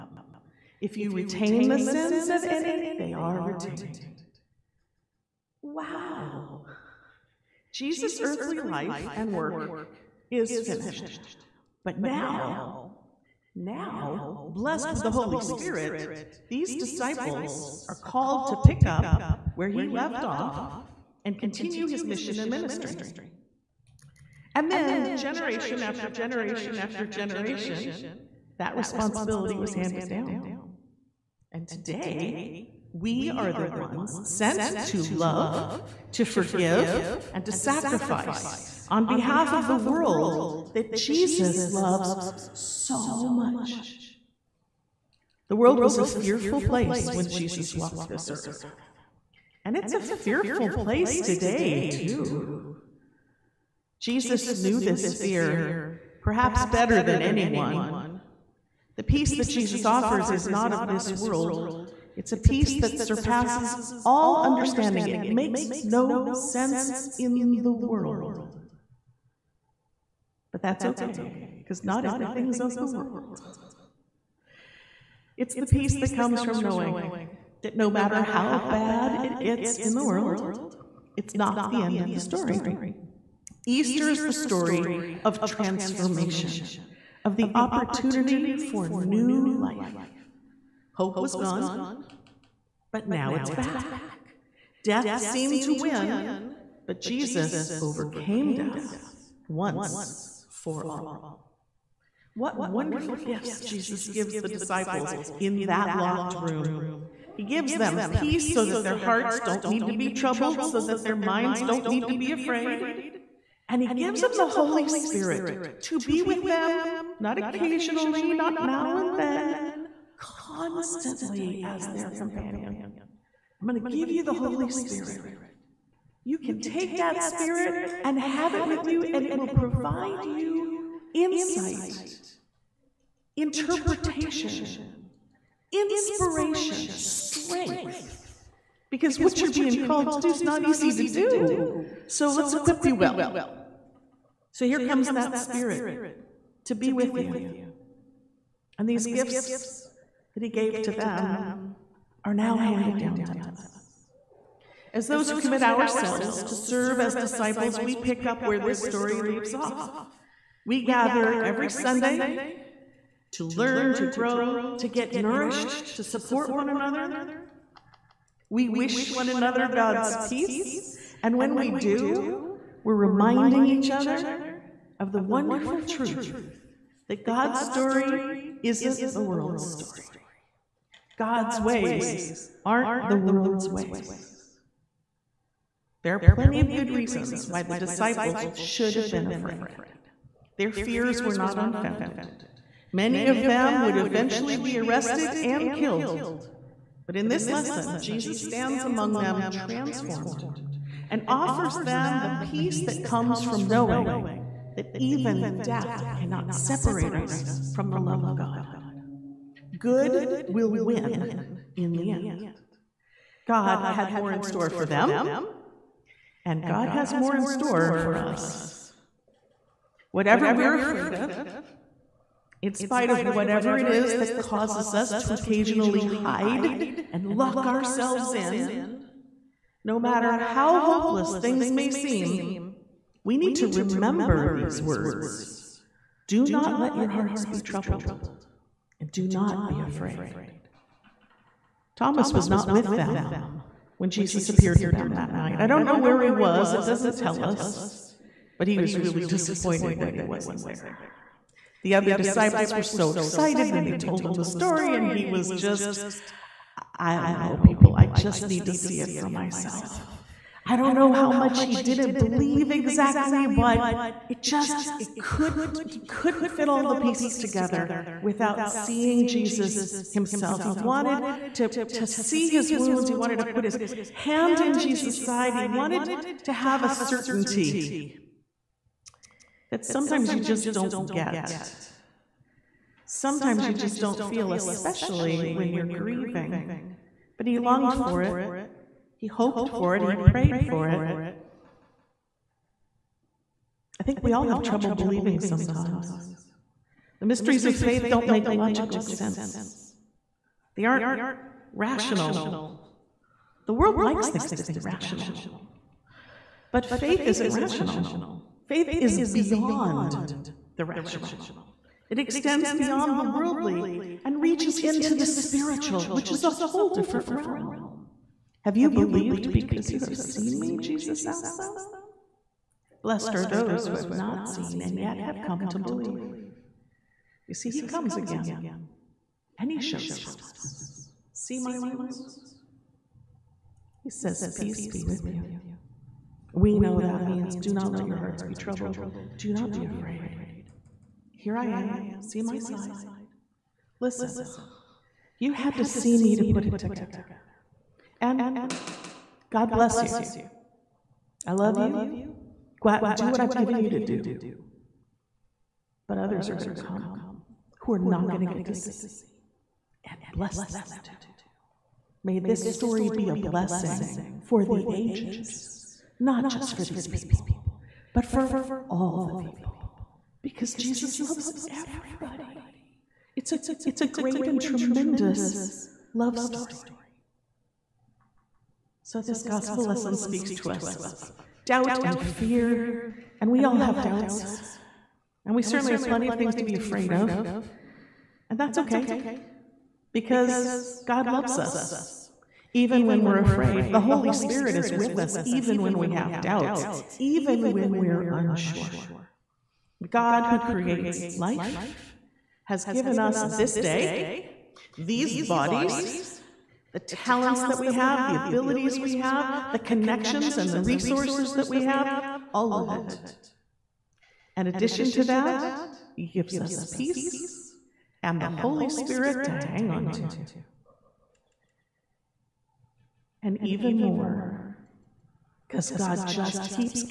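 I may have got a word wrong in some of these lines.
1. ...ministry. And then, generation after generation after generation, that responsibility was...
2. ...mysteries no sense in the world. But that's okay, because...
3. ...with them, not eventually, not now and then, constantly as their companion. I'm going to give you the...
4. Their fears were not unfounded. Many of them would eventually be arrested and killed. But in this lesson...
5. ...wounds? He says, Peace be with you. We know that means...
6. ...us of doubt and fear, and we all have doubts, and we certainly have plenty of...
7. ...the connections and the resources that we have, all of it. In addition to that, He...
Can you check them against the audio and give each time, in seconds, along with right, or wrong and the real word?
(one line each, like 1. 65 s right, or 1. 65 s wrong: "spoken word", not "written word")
1. 22 s right
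2. 65 s wrong: "makes", not "mysteries"
3. 116 s wrong: "occasionally", not "eventually"
4. 190 s right
5. 331 s right
6. 380 s right
7. 409 s right.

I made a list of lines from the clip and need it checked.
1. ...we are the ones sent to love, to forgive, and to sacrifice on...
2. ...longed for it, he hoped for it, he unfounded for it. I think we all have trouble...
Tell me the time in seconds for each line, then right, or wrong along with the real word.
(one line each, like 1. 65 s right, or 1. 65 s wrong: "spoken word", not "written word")
1. 32 s right
2. 287 s wrong: "prayed", not "unfounded".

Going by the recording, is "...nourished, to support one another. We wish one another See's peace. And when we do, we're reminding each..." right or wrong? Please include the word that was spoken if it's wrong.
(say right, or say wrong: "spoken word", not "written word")
wrong: "God", not "See".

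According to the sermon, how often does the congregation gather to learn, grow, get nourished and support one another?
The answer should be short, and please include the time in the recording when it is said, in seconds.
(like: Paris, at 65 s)
Every Sunday, at 161 s.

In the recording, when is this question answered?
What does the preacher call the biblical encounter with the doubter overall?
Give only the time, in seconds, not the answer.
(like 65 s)
376 s.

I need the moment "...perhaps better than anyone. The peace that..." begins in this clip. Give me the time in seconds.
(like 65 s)
56 s.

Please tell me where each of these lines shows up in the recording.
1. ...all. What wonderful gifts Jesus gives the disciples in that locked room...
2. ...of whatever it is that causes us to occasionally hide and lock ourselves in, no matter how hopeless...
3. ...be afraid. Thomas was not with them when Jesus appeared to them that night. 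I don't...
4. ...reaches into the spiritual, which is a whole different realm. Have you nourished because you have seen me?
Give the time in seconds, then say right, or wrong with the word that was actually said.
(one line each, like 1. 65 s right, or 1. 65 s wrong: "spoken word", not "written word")
1. 100 s right
2. 223 s right
3. 239 s right
4. 314 s wrong: "believed", not "nourished".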